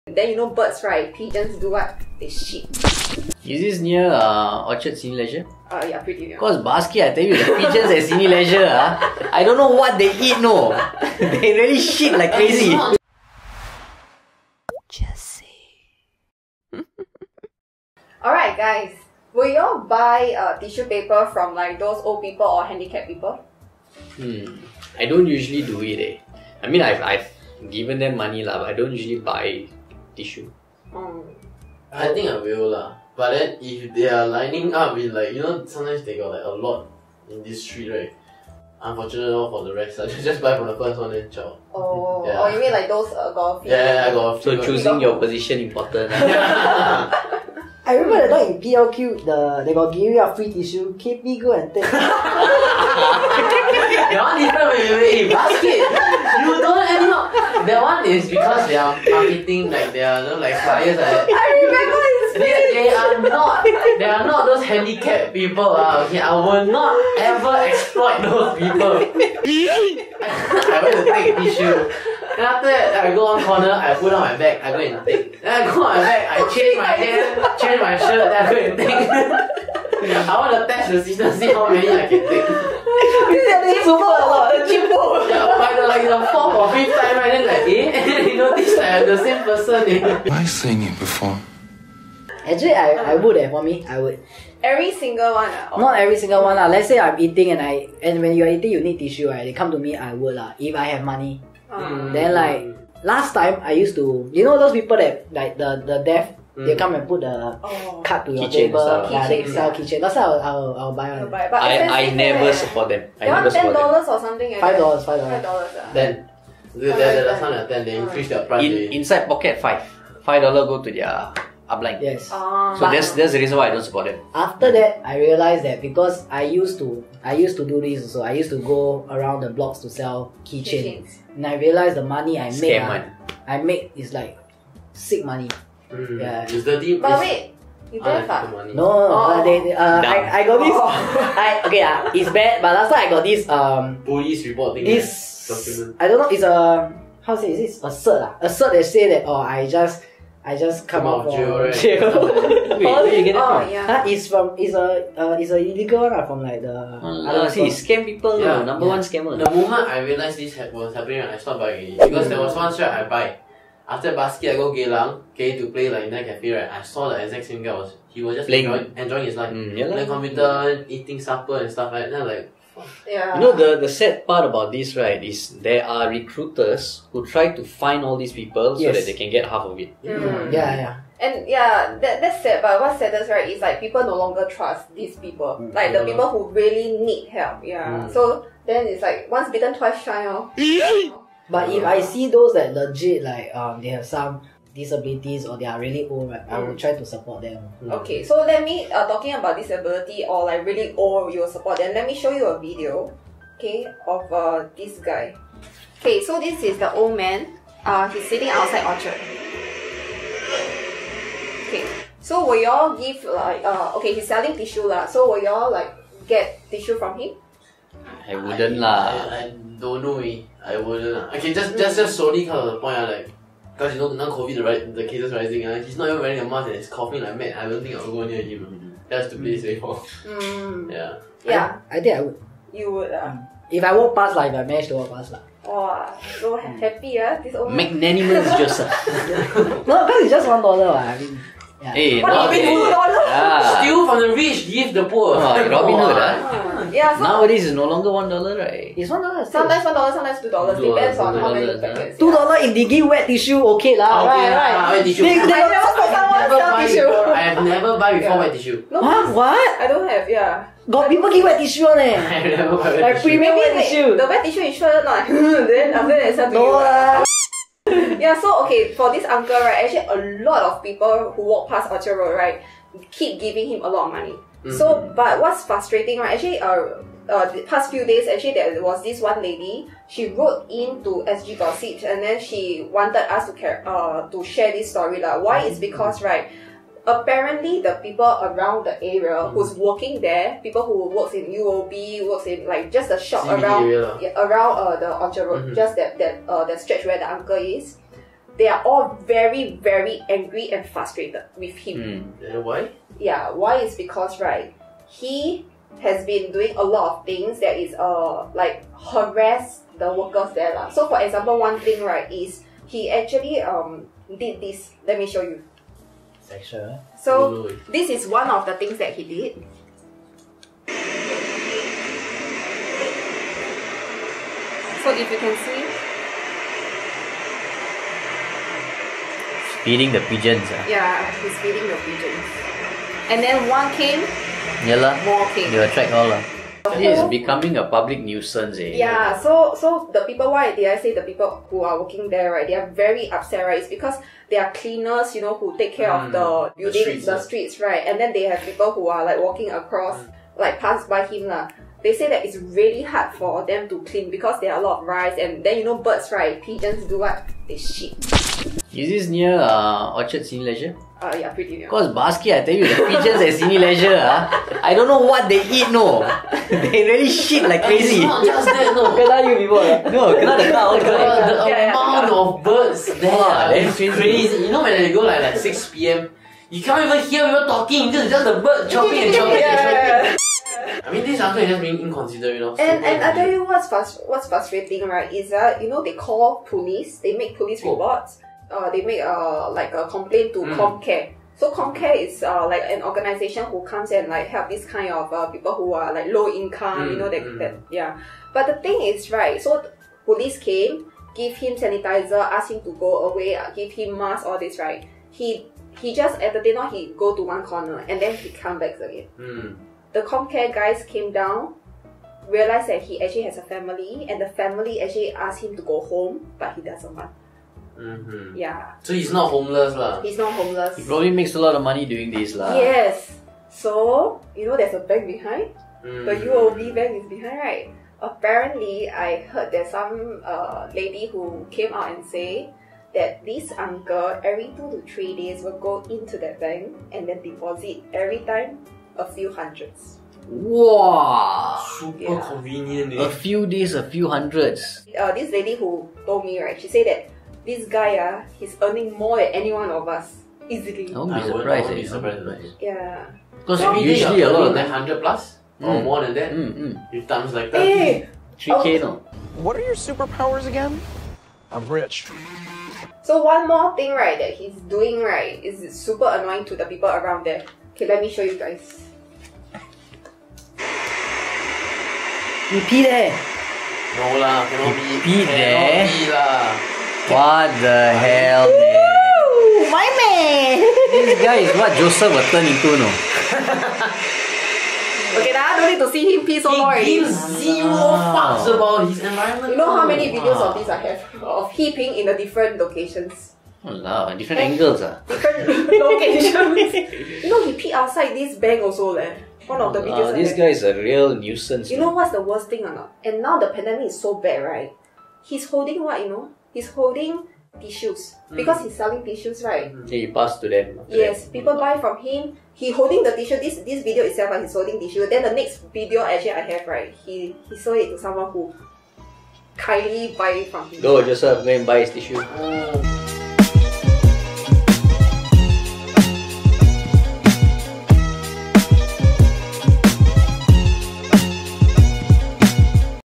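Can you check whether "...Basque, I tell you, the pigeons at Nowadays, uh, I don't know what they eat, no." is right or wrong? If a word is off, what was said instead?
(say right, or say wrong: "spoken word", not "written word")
wrong: "Cineleisure", not "Nowadays".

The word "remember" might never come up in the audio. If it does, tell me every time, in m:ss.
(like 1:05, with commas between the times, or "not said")
0:47, 1:01.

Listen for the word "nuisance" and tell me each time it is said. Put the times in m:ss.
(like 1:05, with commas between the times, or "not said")
5:38, 8:21.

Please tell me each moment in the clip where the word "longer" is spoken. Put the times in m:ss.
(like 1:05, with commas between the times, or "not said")
3:04, 4:07.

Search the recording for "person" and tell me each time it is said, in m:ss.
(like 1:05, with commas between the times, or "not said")
1:29.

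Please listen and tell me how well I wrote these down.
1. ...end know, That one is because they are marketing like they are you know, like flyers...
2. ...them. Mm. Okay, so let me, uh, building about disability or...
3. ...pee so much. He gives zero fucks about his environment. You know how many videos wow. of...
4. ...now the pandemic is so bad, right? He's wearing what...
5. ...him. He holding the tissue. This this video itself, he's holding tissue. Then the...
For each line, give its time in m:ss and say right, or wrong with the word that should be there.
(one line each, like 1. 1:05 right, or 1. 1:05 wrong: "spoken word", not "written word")
1. 0:56 right
2. 3:17 wrong: "talking", not "building"
3. 8:06 right
4. 8:23 wrong: "holding", not "wearing"
5. 8:32 right.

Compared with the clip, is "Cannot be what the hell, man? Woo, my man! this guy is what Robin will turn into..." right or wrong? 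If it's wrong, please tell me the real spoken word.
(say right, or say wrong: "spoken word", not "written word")
wrong: "Joseph", not "Robin".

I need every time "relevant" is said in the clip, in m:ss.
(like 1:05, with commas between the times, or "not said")
not said.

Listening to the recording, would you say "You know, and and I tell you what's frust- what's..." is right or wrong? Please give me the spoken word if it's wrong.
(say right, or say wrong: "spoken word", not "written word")
right.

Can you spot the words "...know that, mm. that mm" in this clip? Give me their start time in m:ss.
6:37.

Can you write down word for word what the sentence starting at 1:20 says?
I want to test the system, see how many I can take.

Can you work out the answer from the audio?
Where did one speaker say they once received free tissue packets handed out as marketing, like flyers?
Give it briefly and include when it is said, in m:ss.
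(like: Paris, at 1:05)
PLQ, at 0:48.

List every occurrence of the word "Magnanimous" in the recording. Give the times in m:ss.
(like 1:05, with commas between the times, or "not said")
3:57.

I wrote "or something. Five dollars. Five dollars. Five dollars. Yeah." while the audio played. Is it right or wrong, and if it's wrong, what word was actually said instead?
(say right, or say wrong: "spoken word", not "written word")
right.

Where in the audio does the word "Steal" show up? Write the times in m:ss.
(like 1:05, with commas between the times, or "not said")
4:03.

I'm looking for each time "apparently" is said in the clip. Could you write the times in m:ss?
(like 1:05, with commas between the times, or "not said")
4:47, 7:08.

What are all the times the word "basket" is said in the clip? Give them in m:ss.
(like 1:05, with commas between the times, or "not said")
0:06, 0:55, 2:44.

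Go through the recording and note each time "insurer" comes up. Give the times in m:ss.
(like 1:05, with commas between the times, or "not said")
4:24.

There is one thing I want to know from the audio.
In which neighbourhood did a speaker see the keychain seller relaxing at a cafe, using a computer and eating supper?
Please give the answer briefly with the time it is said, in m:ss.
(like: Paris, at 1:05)
Geylang, at 2:44.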